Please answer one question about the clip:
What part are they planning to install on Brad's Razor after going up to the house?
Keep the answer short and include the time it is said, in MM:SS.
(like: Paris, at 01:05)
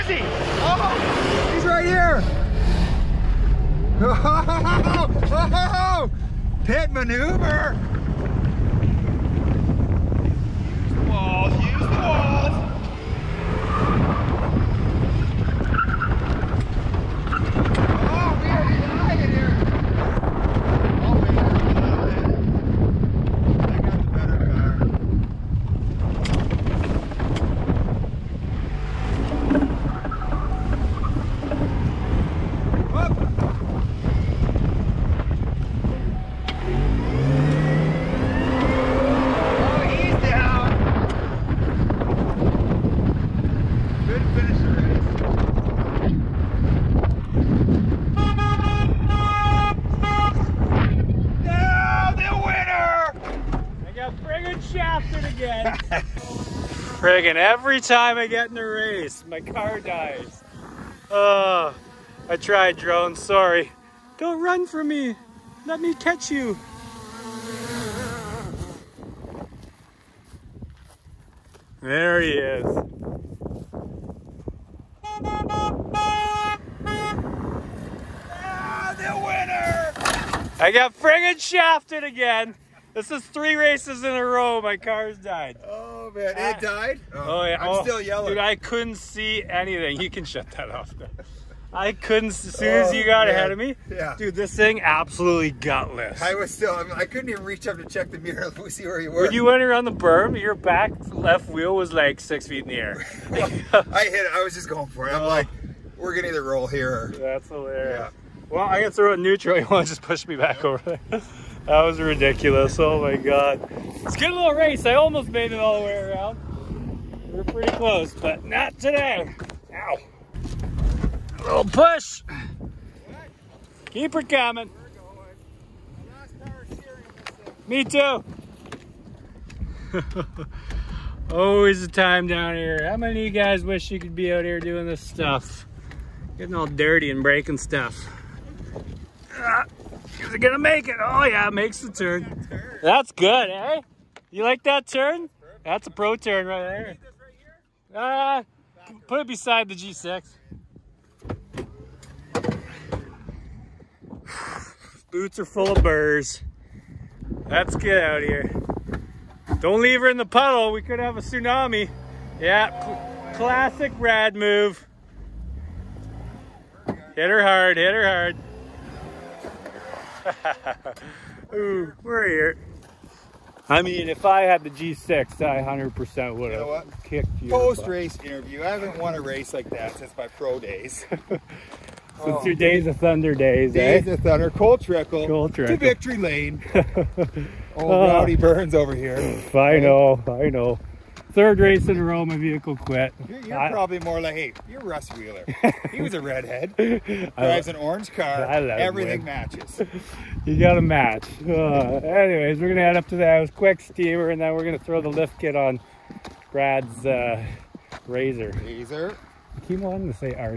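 Lift kit, at 03:25.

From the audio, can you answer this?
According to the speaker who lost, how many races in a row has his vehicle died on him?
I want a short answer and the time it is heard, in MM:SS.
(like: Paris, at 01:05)
3, at 01:23.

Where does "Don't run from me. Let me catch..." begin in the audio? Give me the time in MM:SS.
01:04.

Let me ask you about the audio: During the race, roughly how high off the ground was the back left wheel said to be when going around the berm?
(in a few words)
6 feet.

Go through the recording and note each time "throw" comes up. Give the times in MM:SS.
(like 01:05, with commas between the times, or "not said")
01:48, 03:24.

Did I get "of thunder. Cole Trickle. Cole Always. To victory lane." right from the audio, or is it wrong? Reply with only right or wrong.
wrong.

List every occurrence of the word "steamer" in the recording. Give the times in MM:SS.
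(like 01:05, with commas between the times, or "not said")
03:23.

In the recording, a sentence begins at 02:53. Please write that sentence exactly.
I mean, if I had the G6, I 100% would have you know kicked you.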